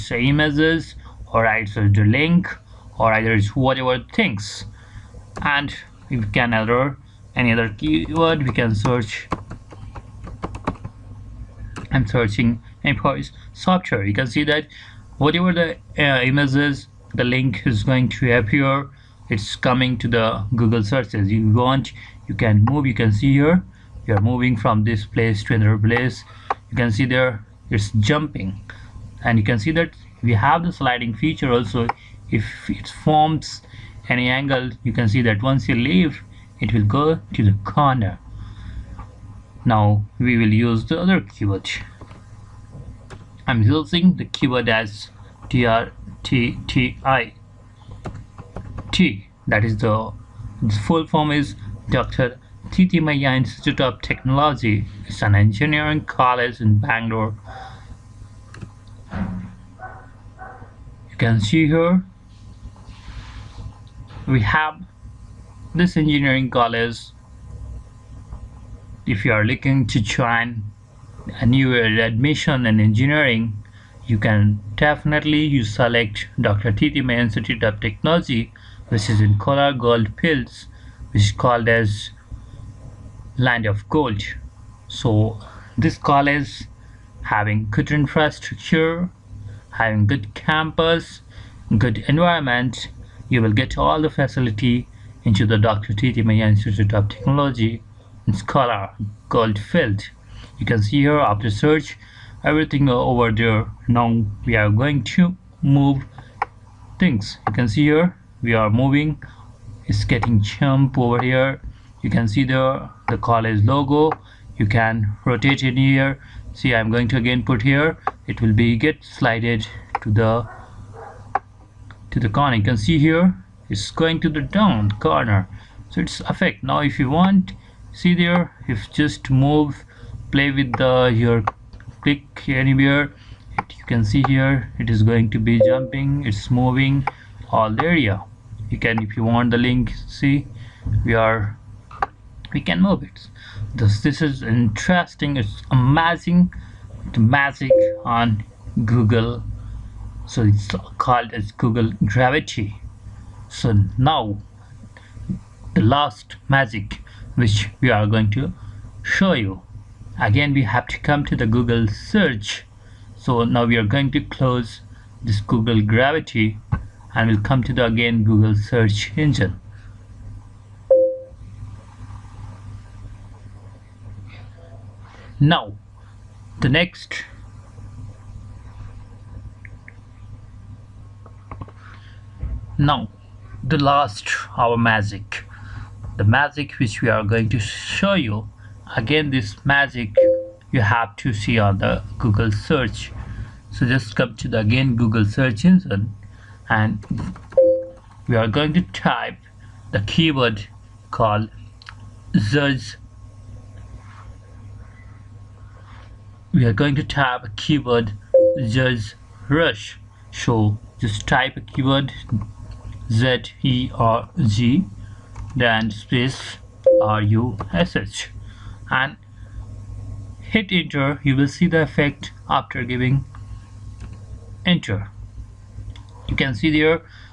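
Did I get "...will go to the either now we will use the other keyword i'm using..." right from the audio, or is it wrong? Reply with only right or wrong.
wrong.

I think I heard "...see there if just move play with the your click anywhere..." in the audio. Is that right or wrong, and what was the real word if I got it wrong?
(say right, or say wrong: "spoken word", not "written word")
right.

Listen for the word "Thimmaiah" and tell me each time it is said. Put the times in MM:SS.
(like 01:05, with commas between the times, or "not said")
00:52, 01:16, 01:36.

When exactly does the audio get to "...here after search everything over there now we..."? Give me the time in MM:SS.
01:41.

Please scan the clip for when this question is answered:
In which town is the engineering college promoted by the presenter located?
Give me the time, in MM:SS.
01:19.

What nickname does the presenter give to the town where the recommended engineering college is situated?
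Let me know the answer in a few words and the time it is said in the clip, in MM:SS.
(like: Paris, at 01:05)
land of gold, at 01:23.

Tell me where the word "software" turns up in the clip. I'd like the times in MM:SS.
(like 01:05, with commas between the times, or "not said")
00:13.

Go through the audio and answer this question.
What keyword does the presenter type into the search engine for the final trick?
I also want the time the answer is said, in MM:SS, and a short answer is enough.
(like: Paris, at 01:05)
Zerg rush, at 03:28.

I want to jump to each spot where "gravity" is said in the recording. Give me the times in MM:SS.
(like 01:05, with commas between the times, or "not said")
02:32, 02:45.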